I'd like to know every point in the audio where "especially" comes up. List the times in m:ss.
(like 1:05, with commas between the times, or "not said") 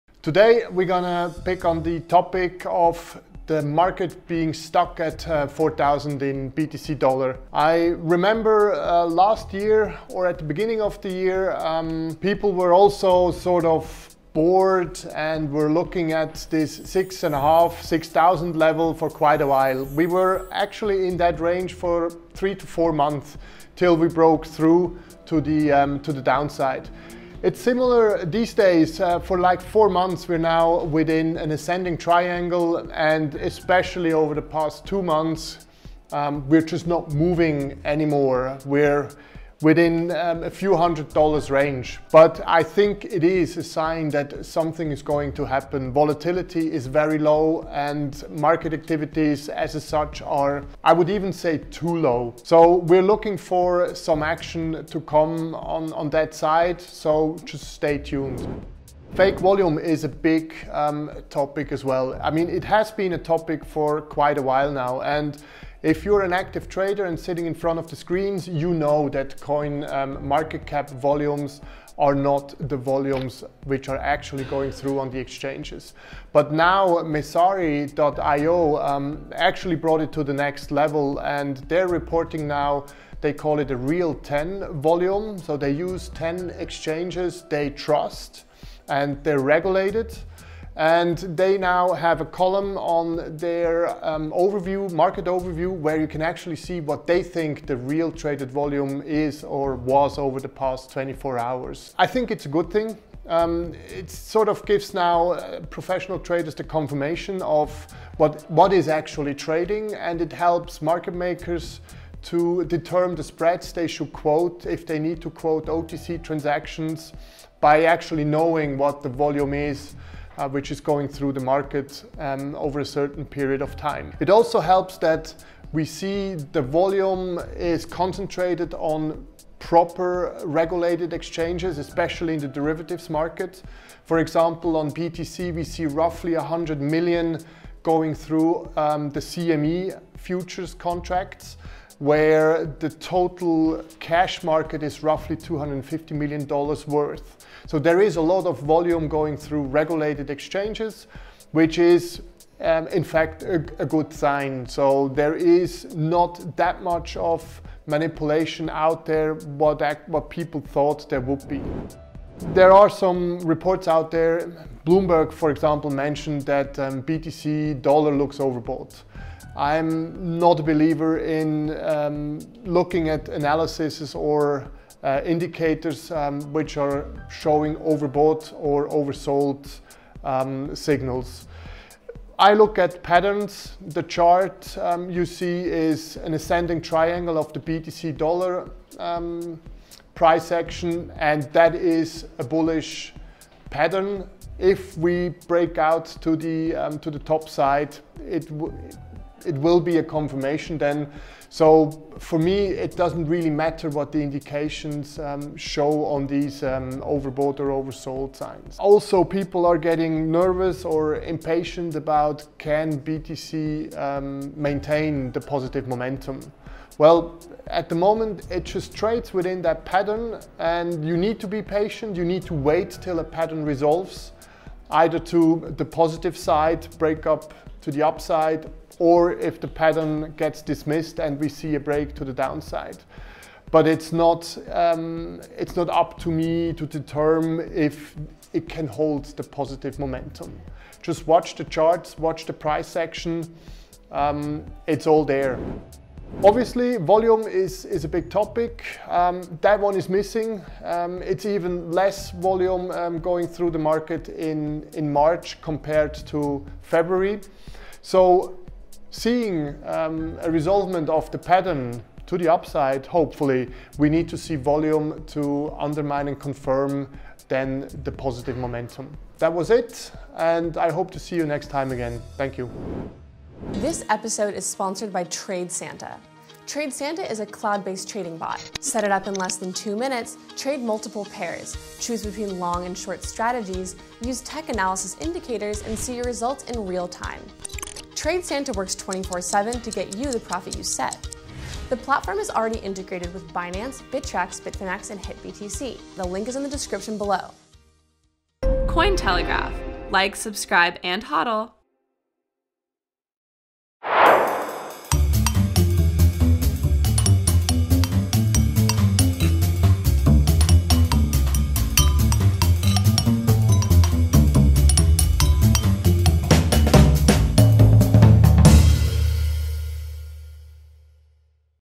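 0:33, 2:11.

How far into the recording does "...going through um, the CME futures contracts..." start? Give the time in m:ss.
2:17.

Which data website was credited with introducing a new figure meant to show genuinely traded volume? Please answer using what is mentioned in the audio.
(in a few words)
Messari.io.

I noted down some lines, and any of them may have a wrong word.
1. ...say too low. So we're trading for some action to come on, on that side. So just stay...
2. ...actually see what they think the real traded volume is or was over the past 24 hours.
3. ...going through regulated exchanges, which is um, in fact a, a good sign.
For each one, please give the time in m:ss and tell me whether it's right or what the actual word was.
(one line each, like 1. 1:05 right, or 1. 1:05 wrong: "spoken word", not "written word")
1. 0:51 wrong: "looking", not "trading"
2. 1:36 right
3. 2:29 right.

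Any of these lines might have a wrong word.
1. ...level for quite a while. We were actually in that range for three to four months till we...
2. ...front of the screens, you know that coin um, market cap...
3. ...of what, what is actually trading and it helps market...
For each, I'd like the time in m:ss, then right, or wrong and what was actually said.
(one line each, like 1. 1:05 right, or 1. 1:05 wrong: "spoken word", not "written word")
1. 0:18 right
2. 1:07 right
3. 1:47 right.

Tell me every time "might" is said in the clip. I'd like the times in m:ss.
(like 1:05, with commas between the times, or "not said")
not said.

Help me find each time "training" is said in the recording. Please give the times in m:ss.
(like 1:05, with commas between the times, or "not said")
not said.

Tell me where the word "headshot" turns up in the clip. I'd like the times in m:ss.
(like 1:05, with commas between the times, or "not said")
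not said.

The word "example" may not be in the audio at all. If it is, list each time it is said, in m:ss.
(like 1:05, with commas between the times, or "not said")
2:14, 2:45.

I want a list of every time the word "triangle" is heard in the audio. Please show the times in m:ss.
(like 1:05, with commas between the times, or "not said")
0:31, 3:06.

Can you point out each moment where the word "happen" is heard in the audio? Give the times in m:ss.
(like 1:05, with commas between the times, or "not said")
0:45.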